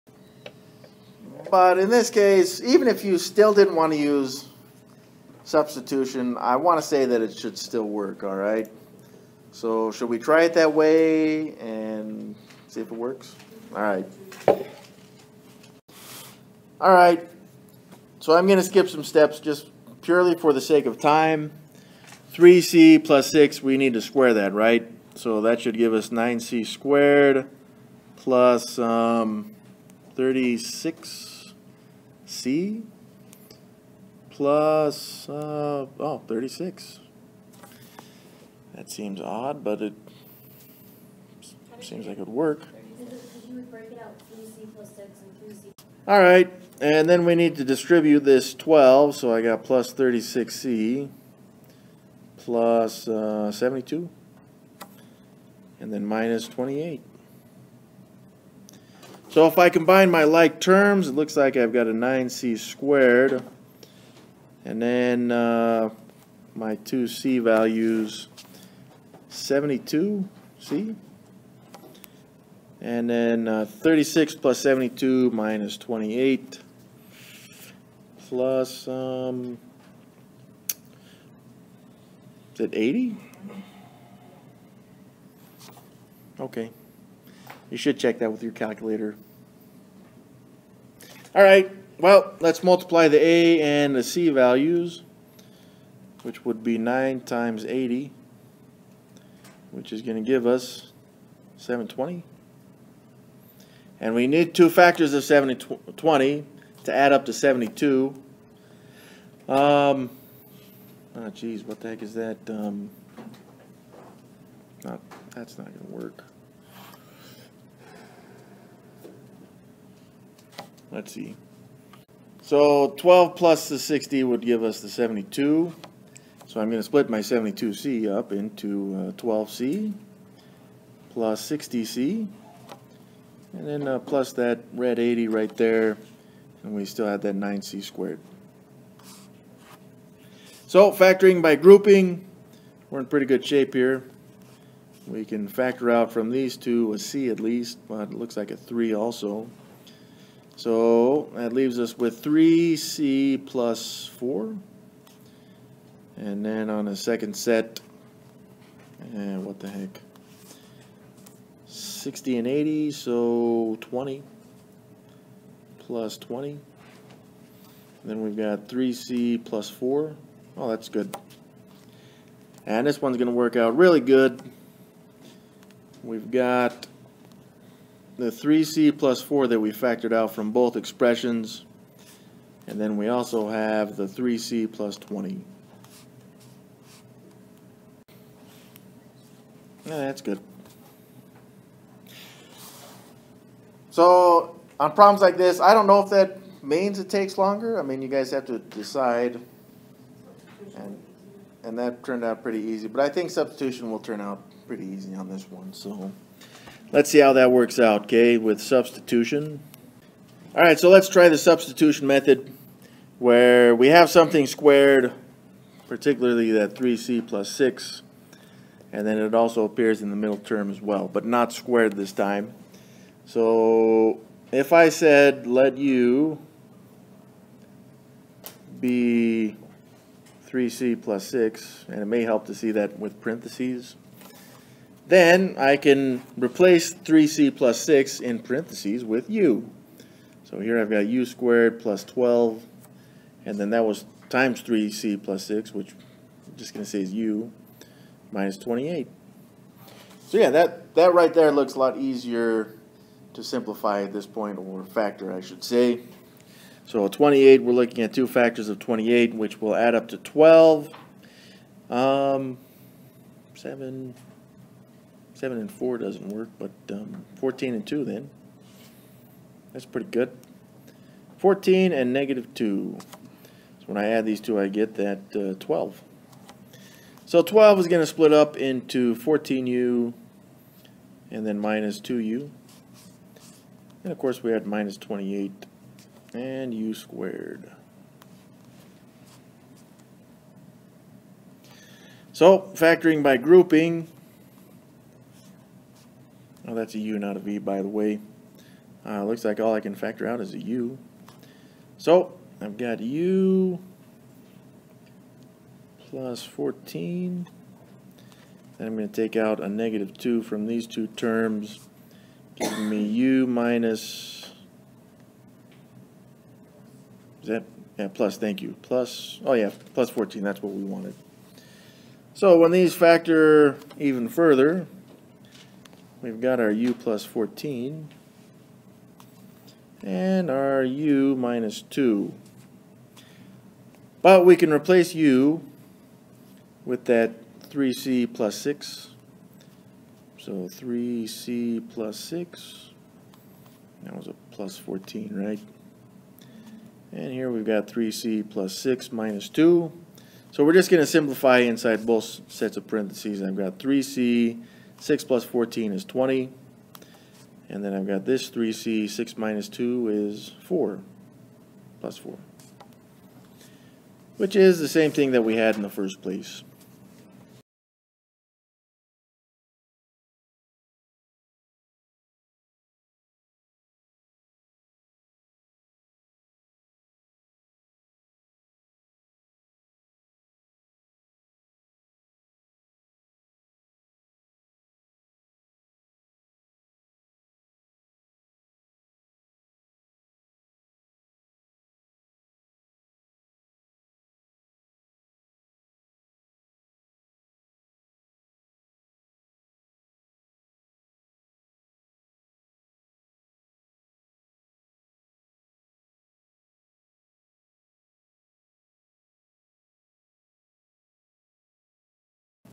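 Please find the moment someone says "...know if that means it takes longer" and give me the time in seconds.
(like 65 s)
195 s.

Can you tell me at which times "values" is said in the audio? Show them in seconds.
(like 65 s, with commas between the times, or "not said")
67 s, 94 s.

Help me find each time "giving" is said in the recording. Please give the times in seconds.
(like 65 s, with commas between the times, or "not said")
312 s.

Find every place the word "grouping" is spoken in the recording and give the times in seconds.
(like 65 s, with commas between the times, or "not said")
141 s, 293 s.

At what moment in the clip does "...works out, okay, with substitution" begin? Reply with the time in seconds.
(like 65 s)
207 s.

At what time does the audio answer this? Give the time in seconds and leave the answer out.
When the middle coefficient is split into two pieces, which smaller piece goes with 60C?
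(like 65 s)
129 s.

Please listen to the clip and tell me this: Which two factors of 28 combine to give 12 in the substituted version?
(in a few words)
14 and negative 2.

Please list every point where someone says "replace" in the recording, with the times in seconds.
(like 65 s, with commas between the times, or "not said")
236 s, 334 s.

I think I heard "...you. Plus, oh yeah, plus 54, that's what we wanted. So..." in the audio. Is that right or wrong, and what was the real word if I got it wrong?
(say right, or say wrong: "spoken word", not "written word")
wrong: "14", not "54".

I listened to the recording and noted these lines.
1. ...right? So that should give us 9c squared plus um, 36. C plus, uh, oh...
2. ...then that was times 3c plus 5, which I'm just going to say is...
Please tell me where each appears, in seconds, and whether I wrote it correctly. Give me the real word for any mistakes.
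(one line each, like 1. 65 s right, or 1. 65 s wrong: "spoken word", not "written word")
1. 24 s right
2. 243 s wrong: "6", not "5".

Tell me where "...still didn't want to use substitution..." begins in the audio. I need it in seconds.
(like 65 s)
3 s.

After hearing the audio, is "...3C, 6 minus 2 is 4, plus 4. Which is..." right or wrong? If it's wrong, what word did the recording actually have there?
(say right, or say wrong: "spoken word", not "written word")
right.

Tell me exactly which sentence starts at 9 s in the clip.
So should we try it that way and see if it works?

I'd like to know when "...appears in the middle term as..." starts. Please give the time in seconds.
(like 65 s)
219 s.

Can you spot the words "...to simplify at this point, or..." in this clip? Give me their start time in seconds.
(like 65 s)
253 s.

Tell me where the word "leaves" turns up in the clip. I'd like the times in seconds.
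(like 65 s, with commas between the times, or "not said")
151 s.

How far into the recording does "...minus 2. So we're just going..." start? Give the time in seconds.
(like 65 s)
349 s.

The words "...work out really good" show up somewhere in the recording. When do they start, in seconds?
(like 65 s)
173 s.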